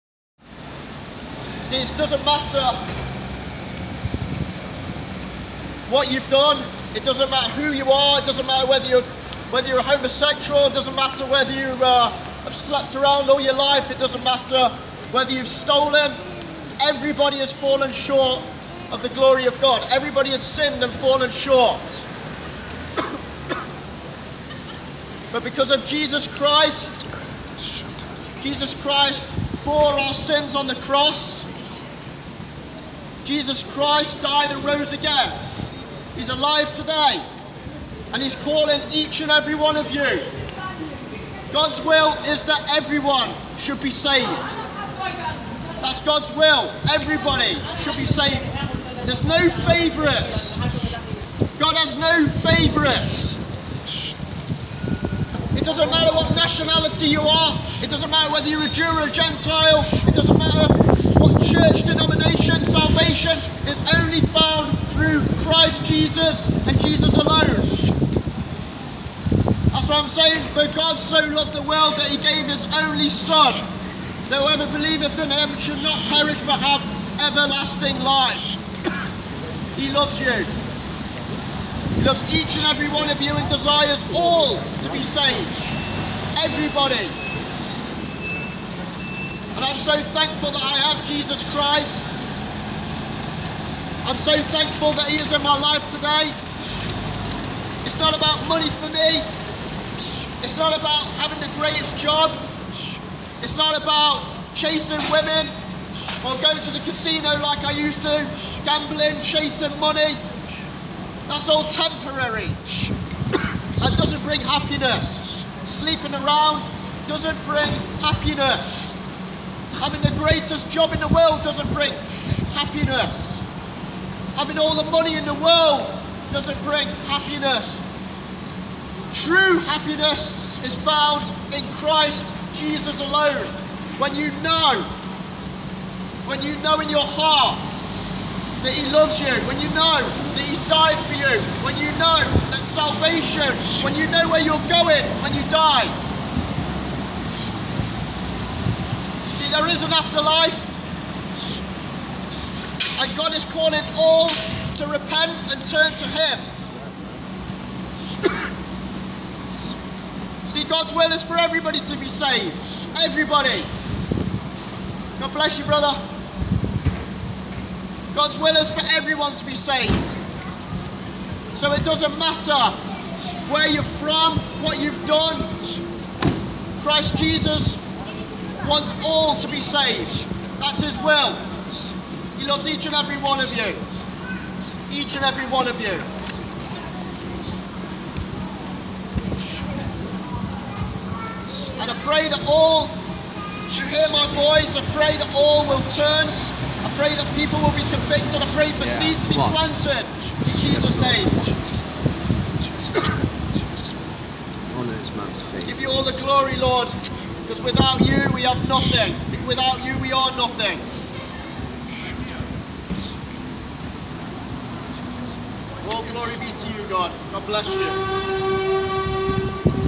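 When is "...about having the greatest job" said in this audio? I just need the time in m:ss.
1:40.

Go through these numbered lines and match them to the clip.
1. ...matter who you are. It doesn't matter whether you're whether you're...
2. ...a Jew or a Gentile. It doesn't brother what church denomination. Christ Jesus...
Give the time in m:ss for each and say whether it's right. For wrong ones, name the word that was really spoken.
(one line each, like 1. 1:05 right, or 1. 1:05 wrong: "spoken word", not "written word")
1. 0:07 right
2. 0:58 wrong: "matter", not "brother".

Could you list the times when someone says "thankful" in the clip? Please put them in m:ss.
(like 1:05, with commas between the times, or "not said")
1:30, 1:34.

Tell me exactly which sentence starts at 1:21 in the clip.
He loves each and every one of you and desires all to be saved.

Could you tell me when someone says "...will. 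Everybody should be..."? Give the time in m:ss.
0:46.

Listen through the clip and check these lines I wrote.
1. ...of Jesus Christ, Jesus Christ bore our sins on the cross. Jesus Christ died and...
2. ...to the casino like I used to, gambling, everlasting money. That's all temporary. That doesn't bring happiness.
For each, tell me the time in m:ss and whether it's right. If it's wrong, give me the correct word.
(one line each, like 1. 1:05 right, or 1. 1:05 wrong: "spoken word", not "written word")
1. 0:25 right
2. 1:46 wrong: "chasing", not "everlasting".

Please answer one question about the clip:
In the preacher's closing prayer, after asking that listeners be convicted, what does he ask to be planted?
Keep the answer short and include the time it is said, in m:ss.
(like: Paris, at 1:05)
seeds, at 3:18.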